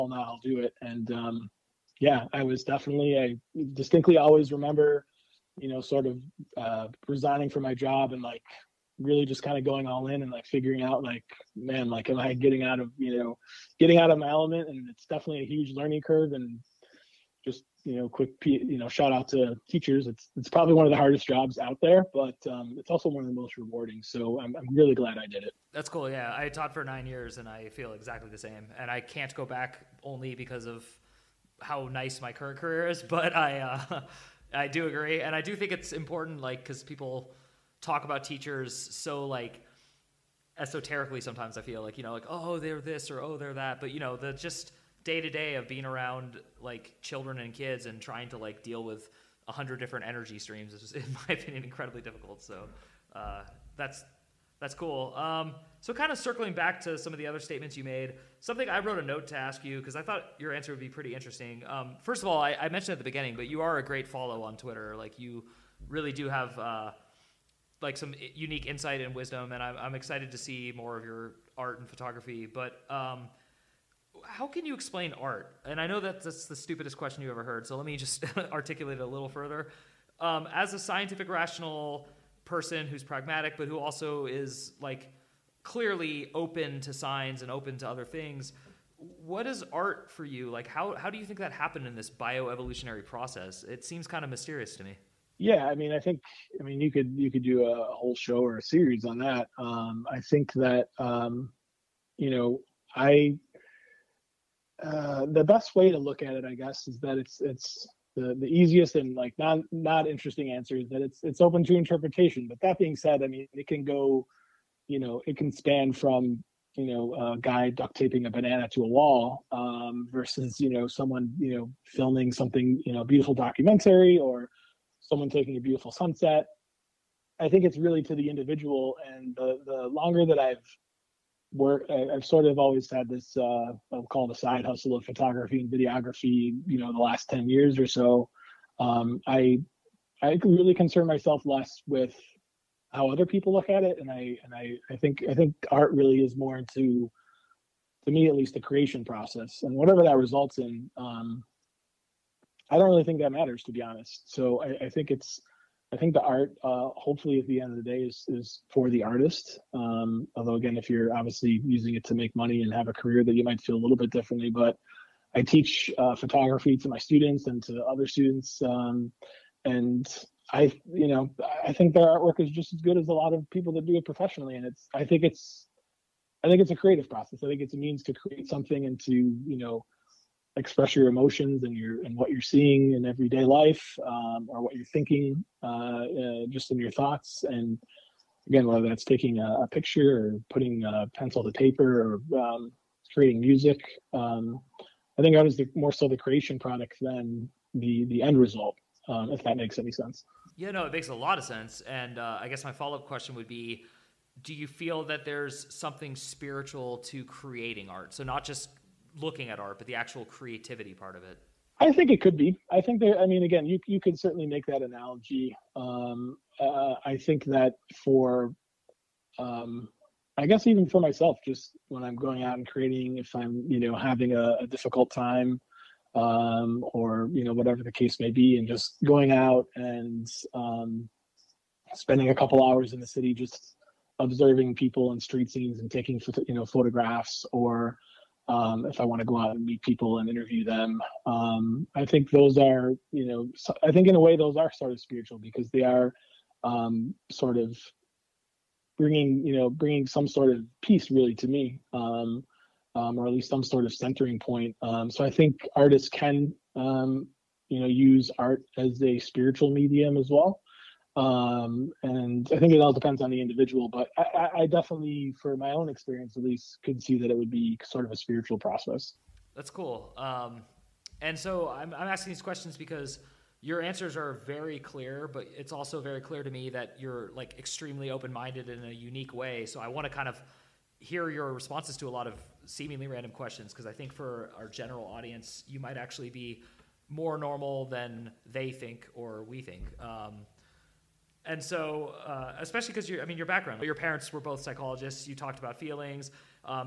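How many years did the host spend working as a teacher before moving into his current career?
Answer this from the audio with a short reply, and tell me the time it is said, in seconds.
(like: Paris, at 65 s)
9, at 26 s.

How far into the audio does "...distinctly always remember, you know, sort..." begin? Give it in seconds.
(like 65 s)
3 s.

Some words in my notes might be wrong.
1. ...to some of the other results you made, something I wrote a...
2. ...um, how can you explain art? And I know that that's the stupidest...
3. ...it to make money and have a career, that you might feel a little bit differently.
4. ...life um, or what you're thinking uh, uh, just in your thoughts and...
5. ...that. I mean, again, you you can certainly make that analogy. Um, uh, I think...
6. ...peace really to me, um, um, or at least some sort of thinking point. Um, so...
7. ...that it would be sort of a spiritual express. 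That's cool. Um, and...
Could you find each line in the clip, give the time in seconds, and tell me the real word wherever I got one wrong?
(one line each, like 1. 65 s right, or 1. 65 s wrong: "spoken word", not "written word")
1. 56 s wrong: "statements", not "results"
2. 72 s right
3. 161 s right
4. 183 s right
5. 212 s right
6. 250 s wrong: "centering", not "thinking"
7. 267 s wrong: "process", not "express".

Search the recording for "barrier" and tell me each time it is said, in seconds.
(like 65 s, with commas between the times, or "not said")
not said.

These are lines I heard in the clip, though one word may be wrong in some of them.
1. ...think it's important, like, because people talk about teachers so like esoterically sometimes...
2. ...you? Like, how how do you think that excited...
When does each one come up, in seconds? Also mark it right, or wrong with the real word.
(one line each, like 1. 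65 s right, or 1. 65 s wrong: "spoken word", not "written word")
1. 35 s right
2. 90 s wrong: "happened", not "excited".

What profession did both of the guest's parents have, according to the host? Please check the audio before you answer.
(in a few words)
psychologists.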